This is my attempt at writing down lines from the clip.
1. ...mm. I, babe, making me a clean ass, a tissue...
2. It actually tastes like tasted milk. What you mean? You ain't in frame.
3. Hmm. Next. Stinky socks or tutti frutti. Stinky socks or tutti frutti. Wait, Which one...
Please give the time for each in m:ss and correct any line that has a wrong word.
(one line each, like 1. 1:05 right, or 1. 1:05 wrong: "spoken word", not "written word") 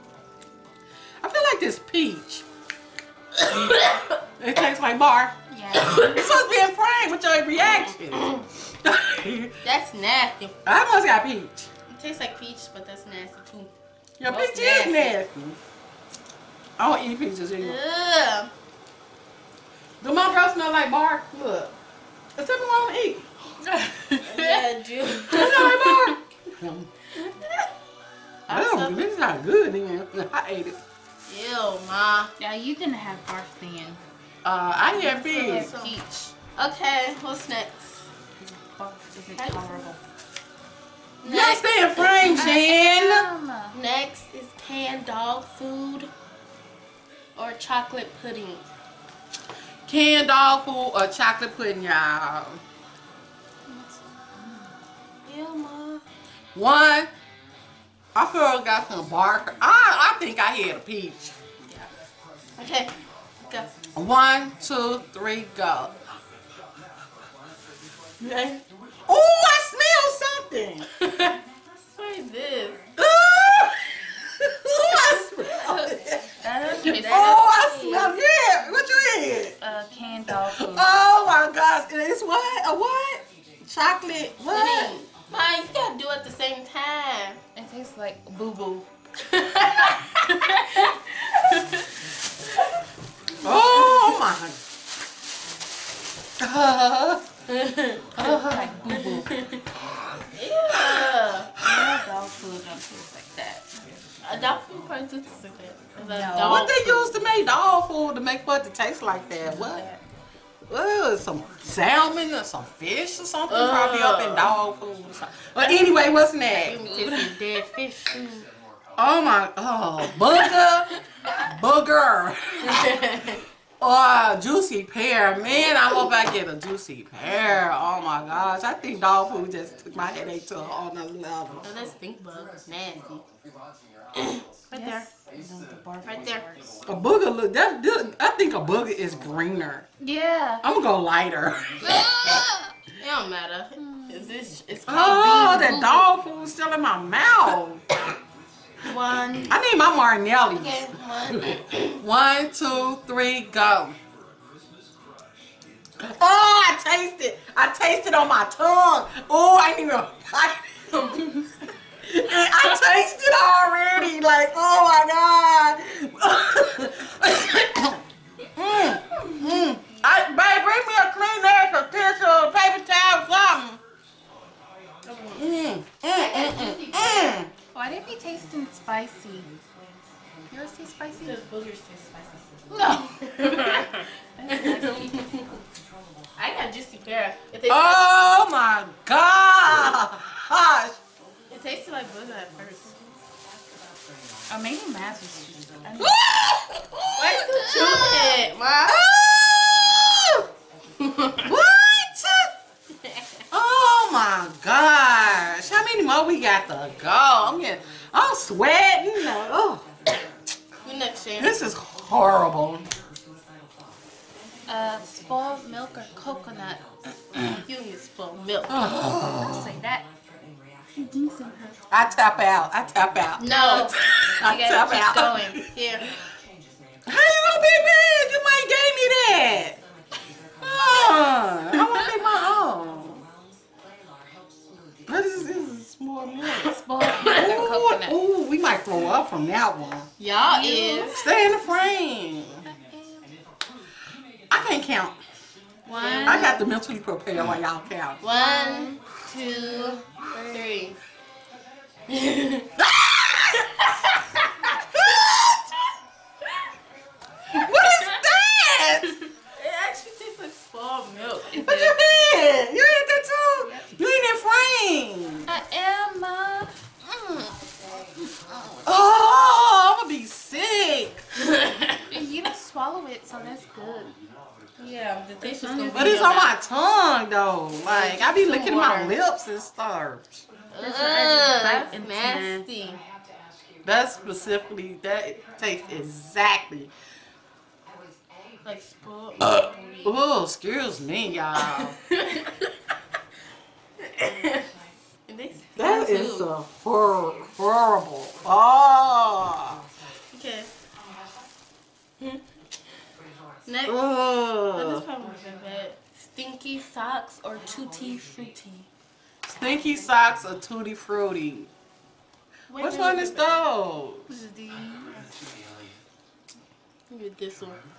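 1. 2:49 wrong: "bring", not "making"
2. 4:19 wrong: "spoiled", not "tasted"
3. 5:02 right.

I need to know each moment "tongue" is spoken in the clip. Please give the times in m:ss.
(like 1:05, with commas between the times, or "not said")
2:38, 4:36.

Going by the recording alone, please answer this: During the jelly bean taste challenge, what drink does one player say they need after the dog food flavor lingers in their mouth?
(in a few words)
Martinellis.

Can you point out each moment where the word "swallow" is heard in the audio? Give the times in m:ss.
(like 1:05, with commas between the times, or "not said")
4:32.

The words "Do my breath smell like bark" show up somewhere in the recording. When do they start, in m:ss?
0:20.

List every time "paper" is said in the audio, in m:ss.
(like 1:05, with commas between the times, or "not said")
2:52.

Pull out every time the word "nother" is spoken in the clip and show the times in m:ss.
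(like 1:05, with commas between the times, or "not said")
2:10.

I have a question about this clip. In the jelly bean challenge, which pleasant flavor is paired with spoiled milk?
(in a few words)
coconut.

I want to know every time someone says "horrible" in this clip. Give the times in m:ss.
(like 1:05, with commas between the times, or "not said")
3:31, 4:57.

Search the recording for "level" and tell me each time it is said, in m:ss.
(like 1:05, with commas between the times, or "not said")
2:11.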